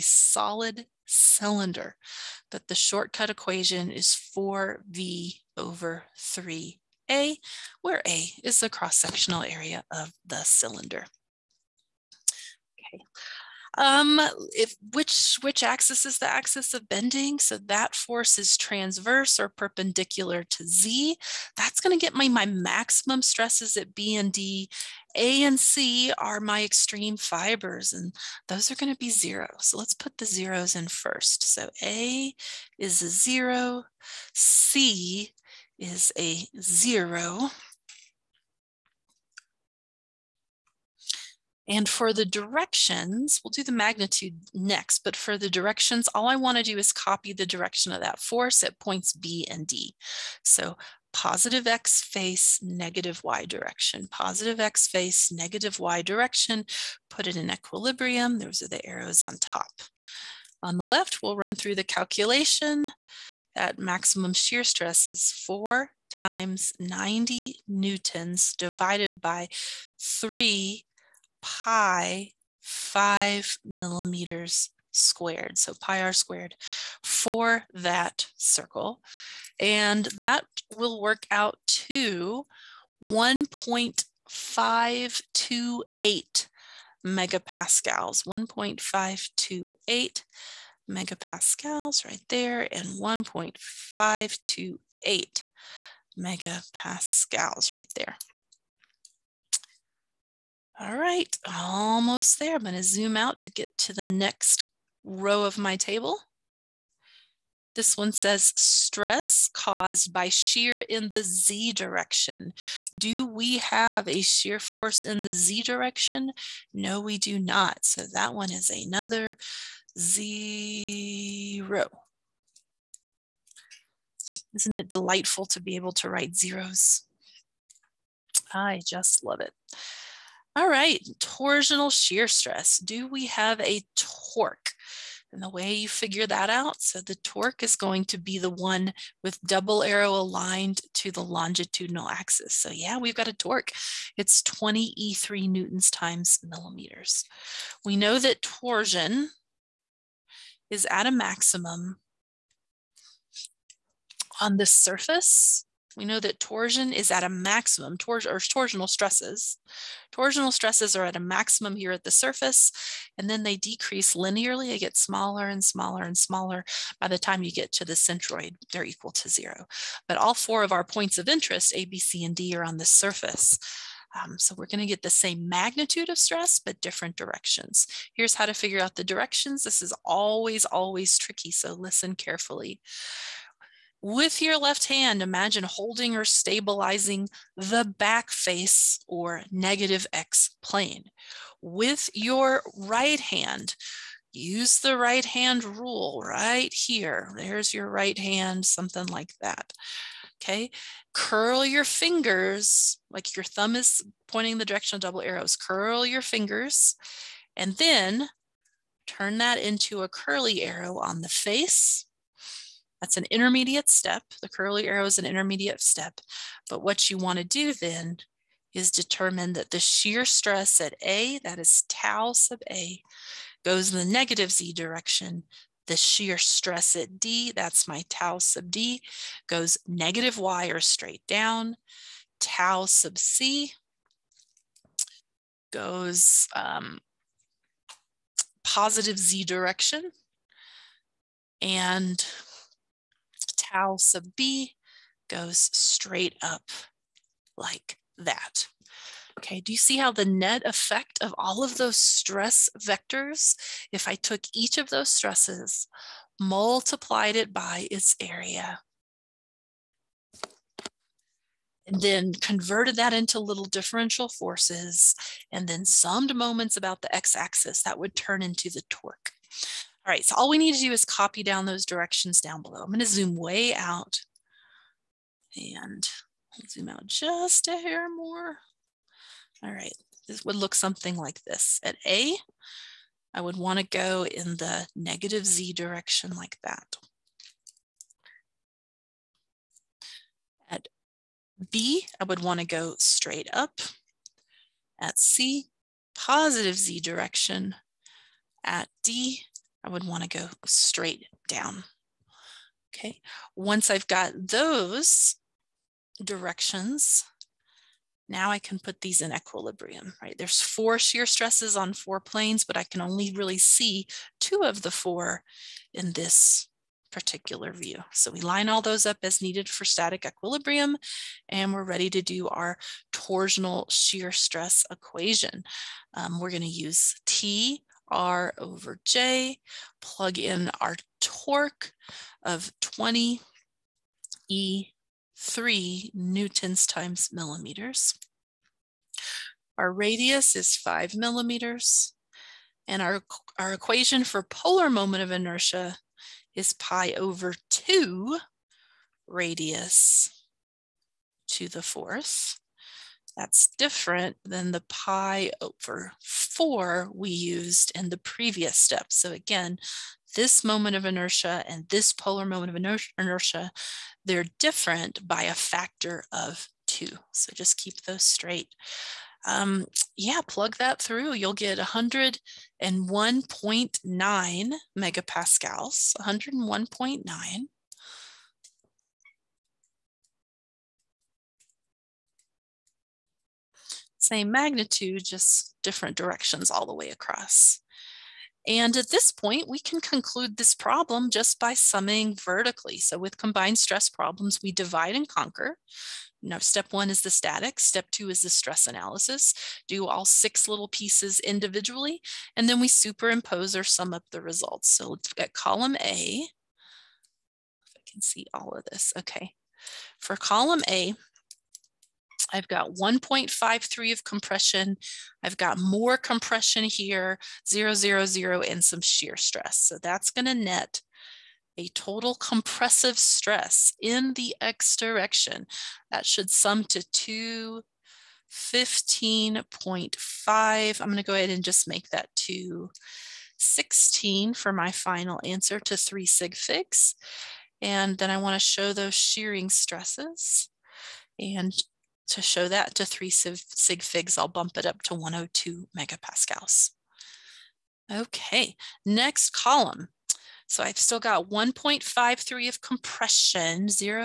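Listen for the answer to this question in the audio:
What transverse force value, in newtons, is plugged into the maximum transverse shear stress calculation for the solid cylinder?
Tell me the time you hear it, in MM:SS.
01:06.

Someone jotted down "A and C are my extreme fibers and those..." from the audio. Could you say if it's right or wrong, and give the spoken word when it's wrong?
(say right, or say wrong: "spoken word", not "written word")
right.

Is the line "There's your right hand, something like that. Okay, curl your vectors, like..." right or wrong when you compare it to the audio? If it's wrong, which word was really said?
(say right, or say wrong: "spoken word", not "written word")
wrong: "fingers", not "vectors".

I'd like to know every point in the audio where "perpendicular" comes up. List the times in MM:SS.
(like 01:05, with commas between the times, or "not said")
00:19.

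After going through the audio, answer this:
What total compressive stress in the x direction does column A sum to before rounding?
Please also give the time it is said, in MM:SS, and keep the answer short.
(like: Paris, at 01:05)
215.5, at 07:07.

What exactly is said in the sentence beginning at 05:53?
That's different than the pi over 4 we used in the previous step.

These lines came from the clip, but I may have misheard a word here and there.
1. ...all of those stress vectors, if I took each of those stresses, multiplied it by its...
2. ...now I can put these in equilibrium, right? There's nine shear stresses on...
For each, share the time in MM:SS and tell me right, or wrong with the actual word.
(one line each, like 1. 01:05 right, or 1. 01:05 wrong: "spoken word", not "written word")
1. 04:11 right
2. 05:08 wrong: "four", not "nine".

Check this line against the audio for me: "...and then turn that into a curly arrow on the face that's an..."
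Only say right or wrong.
right.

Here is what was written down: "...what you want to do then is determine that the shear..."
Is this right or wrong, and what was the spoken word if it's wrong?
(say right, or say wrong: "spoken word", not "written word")
right.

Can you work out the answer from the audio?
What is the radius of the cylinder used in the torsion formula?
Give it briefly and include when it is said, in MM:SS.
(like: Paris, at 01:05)
5 millimeters, at 05:40.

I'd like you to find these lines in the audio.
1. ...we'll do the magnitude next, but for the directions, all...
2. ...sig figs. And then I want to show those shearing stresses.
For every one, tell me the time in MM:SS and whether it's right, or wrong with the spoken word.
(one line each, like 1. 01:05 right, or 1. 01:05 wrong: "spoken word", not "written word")
1. 00:43 right
2. 07:16 right.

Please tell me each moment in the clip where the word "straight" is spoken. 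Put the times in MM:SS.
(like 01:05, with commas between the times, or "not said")
03:50, 04:05, 04:52, 05:00, 06:08.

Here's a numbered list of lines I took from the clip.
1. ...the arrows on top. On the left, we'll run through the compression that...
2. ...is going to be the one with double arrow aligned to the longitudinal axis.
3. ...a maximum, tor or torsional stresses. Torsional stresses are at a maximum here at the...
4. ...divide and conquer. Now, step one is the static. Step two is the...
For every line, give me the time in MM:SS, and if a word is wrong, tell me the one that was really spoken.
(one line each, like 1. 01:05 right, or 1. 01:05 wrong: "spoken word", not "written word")
1. 00:58 wrong: "calculation", not "compression"
2. 02:17 right
3. 02:37 right
4. 06:34 right.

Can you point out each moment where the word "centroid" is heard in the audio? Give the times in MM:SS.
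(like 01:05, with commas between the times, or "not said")
02:47.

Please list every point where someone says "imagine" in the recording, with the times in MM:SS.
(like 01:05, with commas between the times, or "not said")
03:05.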